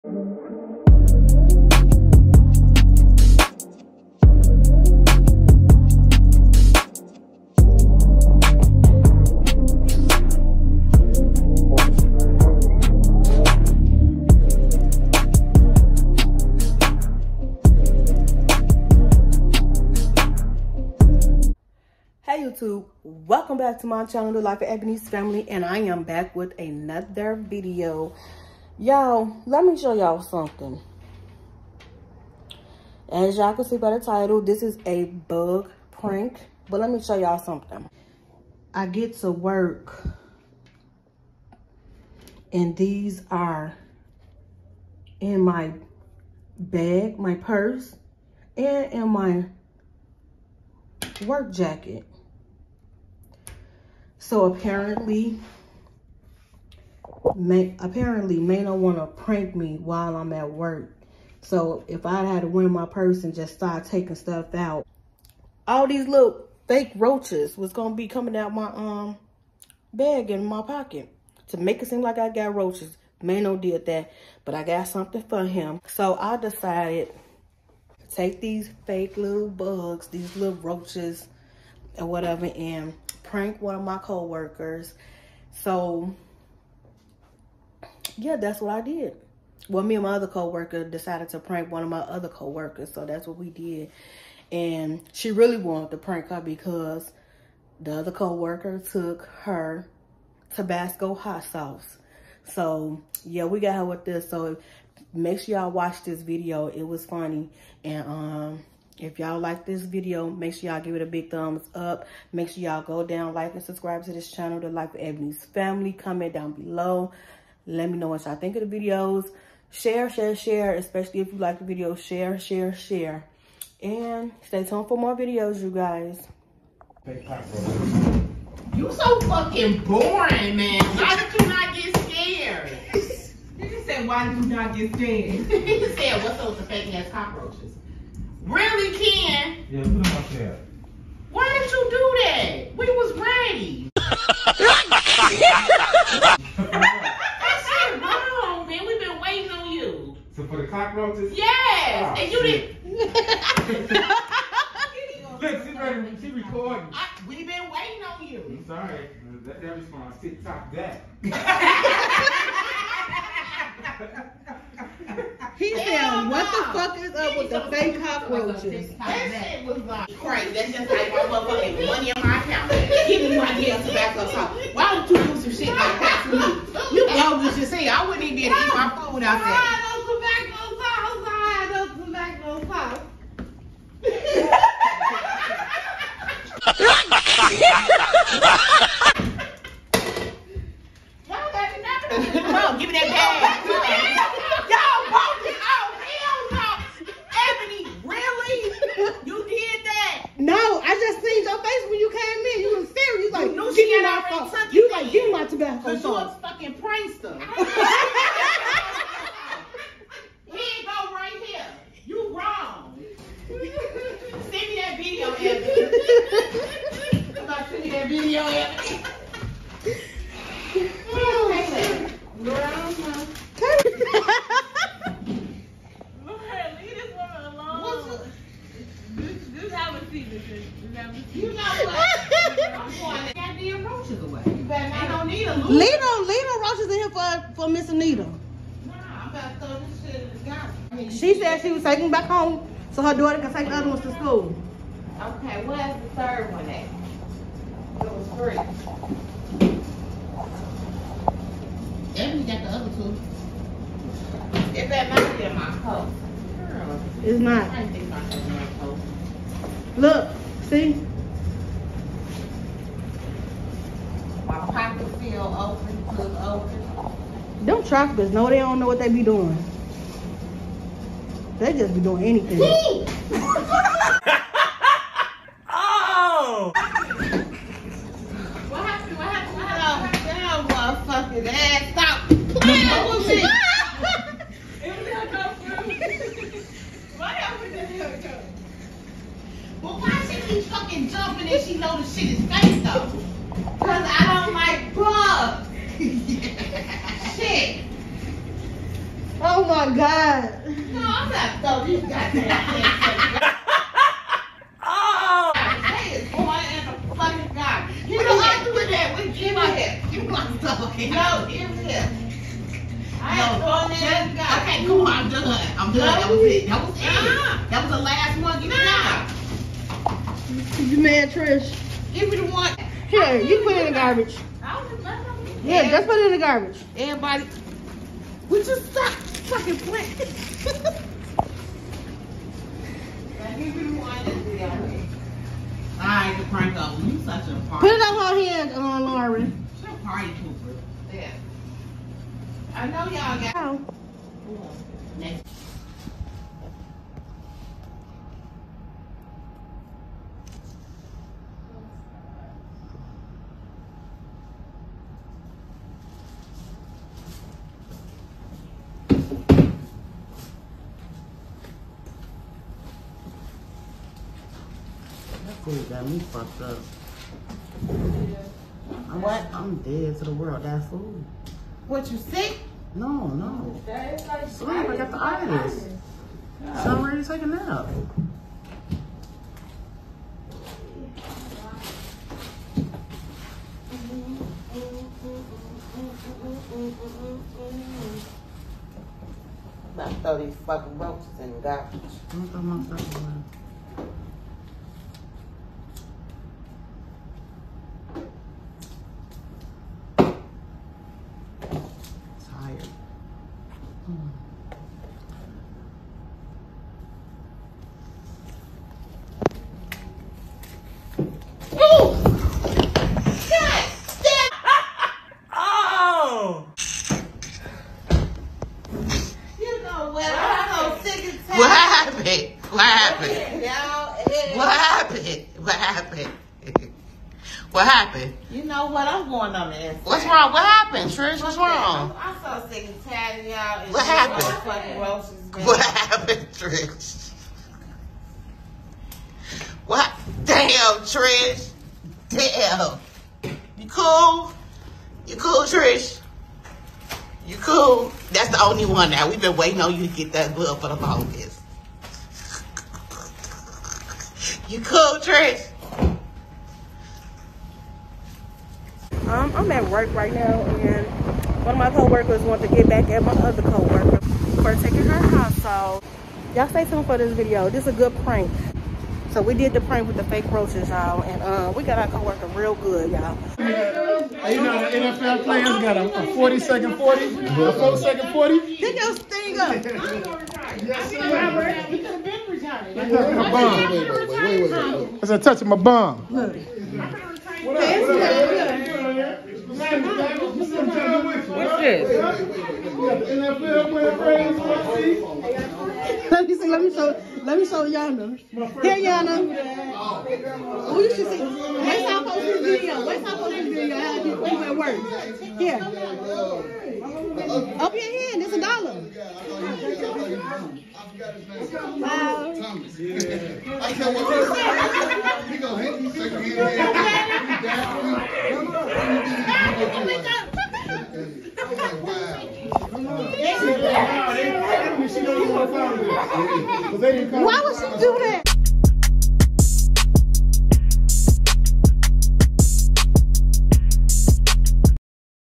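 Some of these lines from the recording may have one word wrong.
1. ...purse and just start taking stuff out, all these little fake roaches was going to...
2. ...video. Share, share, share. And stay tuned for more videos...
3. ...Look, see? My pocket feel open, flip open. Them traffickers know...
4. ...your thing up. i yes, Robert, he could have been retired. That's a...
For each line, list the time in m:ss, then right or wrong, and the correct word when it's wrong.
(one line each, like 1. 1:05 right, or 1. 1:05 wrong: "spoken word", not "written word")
1. 1:02 right
2. 2:01 right
3. 4:19 right
4. 7:58 right.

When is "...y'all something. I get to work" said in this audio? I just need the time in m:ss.
0:37.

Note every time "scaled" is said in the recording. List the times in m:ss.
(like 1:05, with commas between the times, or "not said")
not said.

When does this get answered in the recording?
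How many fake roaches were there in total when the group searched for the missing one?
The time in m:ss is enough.
4:08.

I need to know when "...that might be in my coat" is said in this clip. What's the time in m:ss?
4:14.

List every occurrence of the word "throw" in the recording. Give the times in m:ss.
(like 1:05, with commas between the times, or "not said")
3:59, 5:01, 6:30.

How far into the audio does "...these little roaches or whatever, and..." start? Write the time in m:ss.
1:20.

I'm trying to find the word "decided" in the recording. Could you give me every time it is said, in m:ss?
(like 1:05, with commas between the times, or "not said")
1:16, 1:30.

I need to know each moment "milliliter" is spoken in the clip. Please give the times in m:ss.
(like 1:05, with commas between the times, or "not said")
not said.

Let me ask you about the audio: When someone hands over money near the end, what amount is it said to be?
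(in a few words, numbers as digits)
A dollar.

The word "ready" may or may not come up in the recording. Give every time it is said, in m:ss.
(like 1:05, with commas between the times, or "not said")
2:23, 2:35, 6:17.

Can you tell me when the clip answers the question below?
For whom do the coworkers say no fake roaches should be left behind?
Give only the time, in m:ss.
3:57.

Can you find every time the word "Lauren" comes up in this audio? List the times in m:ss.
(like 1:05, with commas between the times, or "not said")
5:39.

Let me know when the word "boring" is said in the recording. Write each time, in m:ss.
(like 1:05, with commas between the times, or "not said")
2:09.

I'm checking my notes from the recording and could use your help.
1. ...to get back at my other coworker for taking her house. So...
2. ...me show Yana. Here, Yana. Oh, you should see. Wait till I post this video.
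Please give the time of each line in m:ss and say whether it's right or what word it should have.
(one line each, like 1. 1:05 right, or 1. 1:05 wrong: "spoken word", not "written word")
1. 7:42 right
2. 8:17 right.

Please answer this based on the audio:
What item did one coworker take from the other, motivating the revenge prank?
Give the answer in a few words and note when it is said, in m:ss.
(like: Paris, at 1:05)
Tabasco hot sauce, at 1:40.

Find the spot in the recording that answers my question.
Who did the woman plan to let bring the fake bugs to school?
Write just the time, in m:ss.
4:03.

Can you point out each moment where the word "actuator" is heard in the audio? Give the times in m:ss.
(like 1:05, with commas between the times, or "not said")
not said.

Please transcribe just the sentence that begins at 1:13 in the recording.
Mano did that, but I got something for him.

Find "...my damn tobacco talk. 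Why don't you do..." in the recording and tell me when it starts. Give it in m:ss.
2:53.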